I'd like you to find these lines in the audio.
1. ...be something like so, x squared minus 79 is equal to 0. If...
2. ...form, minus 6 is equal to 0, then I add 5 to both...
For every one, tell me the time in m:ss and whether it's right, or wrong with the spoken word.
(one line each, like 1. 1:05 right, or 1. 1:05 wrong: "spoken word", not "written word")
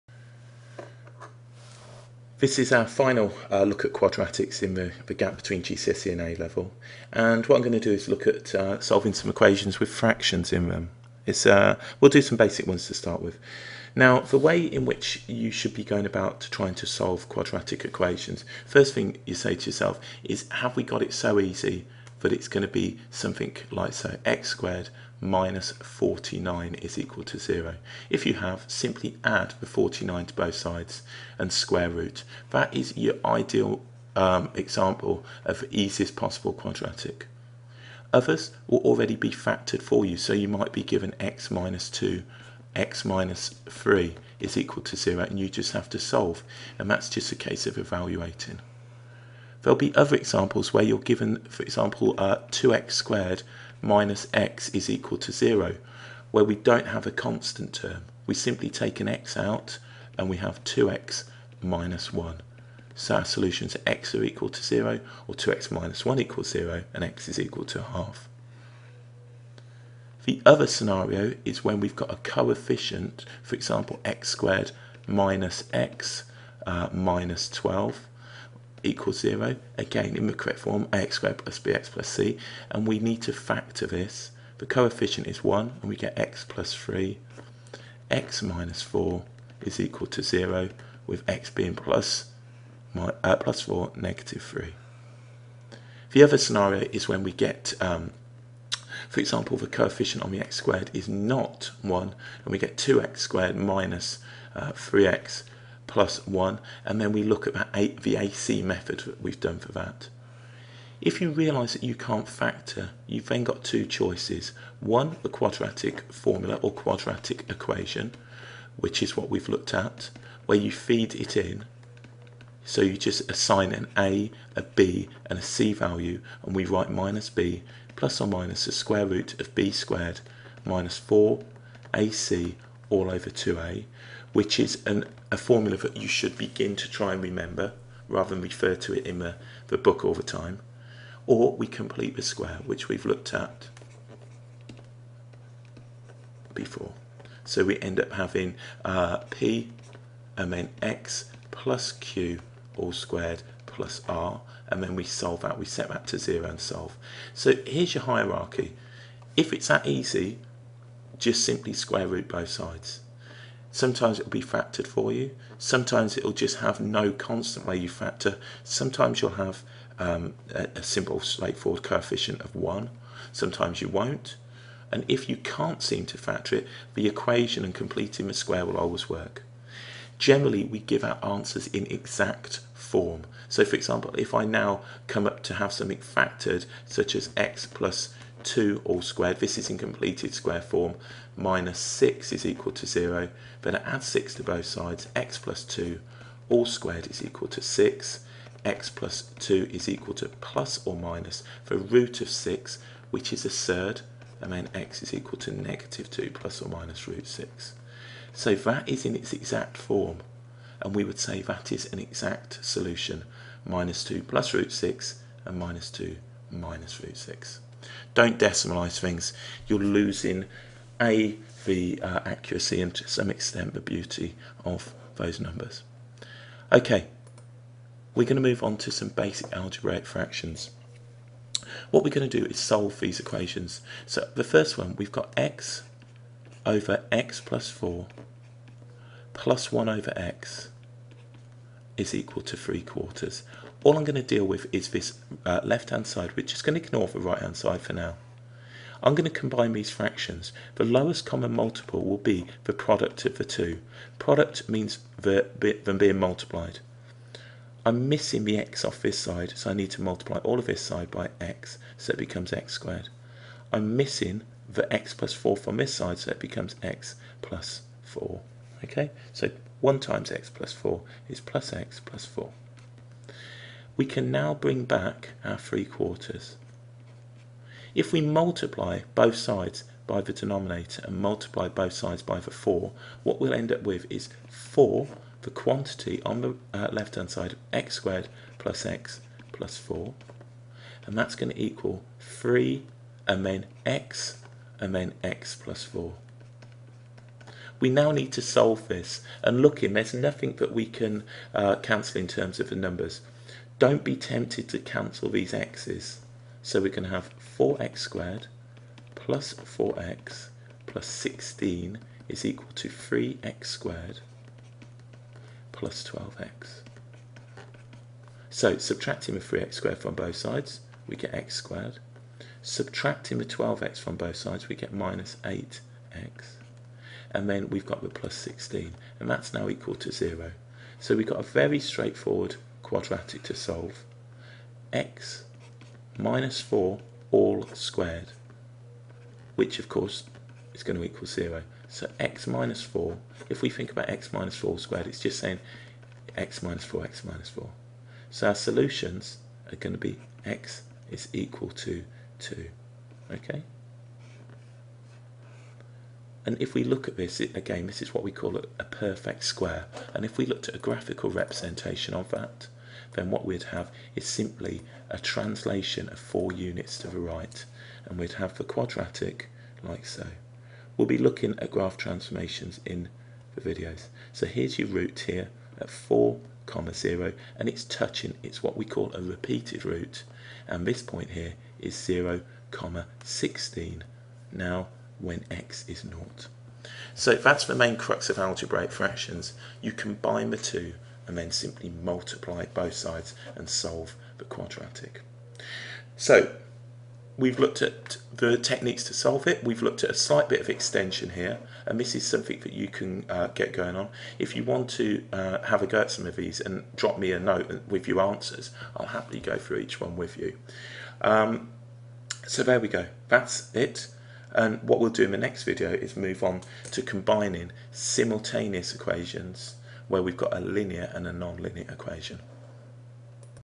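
1. 0:22 wrong: "49", not "79"
2. 3:10 wrong: "6", not "5".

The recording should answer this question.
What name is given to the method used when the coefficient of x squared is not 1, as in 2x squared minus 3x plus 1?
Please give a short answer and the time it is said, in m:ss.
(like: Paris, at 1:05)
AC method, at 1:48.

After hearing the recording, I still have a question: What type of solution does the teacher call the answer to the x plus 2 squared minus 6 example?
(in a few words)
exact solution.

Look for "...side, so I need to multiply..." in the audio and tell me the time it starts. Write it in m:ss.
4:19.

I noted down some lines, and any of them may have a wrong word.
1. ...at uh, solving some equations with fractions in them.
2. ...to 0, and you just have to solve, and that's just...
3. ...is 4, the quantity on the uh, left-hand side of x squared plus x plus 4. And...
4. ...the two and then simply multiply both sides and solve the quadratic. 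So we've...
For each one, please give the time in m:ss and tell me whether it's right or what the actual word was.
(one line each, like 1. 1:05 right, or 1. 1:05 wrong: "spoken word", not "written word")
1. 0:08 right
2. 0:44 right
3. 4:44 right
4. 6:30 right.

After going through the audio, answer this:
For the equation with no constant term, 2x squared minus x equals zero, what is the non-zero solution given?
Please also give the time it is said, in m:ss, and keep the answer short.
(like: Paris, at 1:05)
half, at 1:07.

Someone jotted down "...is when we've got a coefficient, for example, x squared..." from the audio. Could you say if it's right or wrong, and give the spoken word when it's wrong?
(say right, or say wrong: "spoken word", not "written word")
right.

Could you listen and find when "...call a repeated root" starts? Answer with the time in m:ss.
6:18.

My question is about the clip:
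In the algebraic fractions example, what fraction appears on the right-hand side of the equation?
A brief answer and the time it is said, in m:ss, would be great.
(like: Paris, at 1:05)
3/4, at 4:02.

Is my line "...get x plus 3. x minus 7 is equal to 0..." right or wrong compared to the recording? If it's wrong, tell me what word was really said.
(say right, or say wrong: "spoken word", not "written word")
wrong: "4", not "7".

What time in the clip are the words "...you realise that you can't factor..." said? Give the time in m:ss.
1:51.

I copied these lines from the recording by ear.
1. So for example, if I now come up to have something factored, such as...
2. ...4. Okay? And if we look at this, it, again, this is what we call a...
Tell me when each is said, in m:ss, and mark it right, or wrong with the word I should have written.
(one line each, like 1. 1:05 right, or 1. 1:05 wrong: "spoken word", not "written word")
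1. 3:03 right
2. 5:52 wrong: "2", not "4".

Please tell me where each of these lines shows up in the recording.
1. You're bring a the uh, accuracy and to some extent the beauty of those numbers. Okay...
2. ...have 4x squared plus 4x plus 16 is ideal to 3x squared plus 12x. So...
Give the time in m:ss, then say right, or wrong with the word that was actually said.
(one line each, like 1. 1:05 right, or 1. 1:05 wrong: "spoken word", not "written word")
1. 3:39 wrong: "losing", not "bring"
2. 5:07 wrong: "equal", not "ideal".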